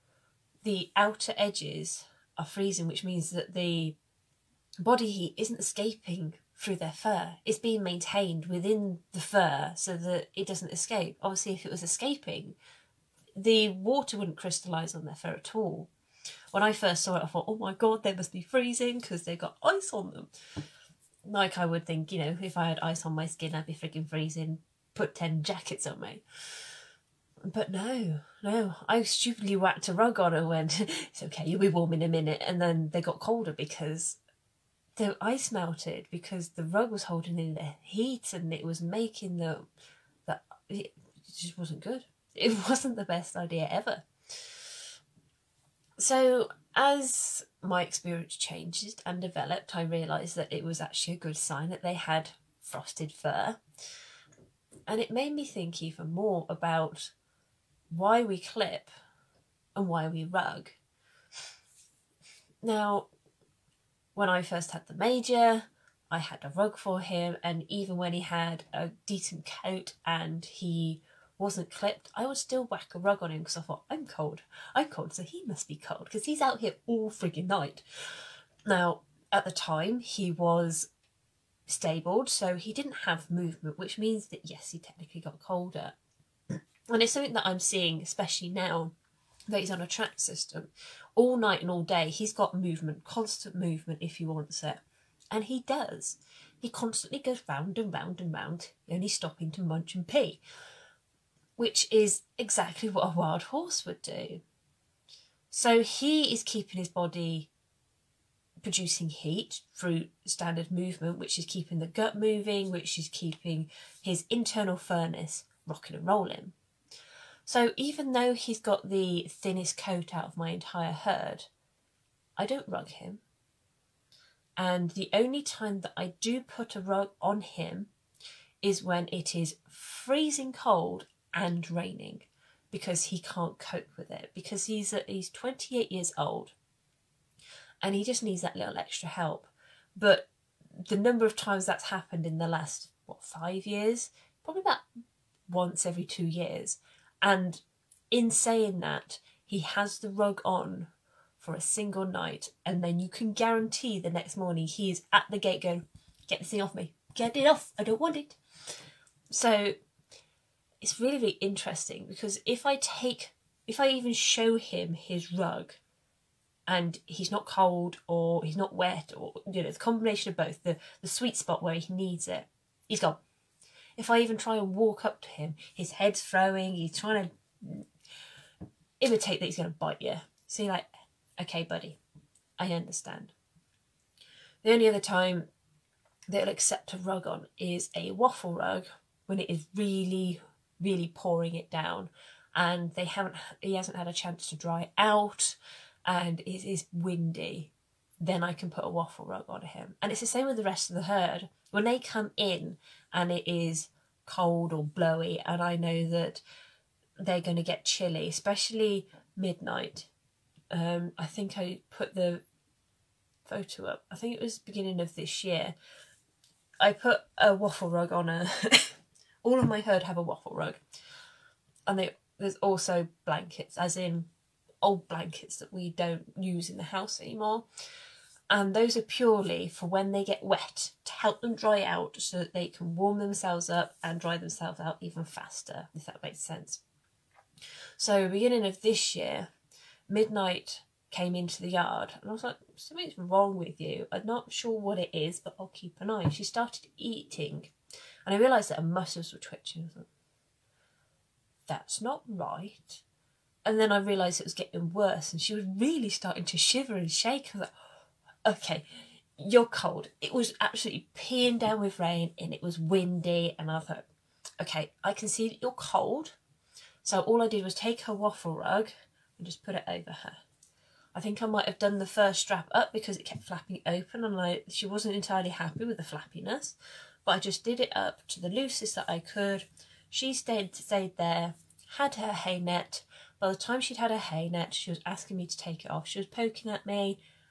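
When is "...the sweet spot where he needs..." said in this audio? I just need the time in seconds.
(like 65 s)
171 s.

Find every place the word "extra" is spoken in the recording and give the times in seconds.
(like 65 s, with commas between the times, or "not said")
138 s.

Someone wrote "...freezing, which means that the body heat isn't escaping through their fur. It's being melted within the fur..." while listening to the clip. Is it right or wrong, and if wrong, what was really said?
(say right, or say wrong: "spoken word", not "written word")
wrong: "maintained", not "melted".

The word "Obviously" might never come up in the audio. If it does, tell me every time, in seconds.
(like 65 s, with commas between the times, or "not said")
11 s.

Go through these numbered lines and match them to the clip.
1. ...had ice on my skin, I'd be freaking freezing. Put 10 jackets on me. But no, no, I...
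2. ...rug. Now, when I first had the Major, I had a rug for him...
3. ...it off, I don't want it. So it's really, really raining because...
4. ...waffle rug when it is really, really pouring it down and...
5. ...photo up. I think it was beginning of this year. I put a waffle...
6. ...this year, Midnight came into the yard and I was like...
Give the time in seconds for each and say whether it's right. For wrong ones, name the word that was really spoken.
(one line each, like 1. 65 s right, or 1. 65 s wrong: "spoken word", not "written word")
1. 22 s right
2. 60 s right
3. 157 s wrong: "interesting", not "raining"
4. 188 s right
5. 213 s right
6. 238 s right.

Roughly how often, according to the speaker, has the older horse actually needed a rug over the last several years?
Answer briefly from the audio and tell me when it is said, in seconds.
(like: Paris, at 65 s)
once every 2 years, at 145 s.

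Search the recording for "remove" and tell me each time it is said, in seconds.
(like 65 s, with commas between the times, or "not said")
not said.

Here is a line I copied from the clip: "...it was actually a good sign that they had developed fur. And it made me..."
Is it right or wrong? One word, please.
wrong.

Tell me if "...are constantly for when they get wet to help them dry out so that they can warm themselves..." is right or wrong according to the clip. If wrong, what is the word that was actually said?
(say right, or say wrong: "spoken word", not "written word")
wrong: "purely", not "constantly".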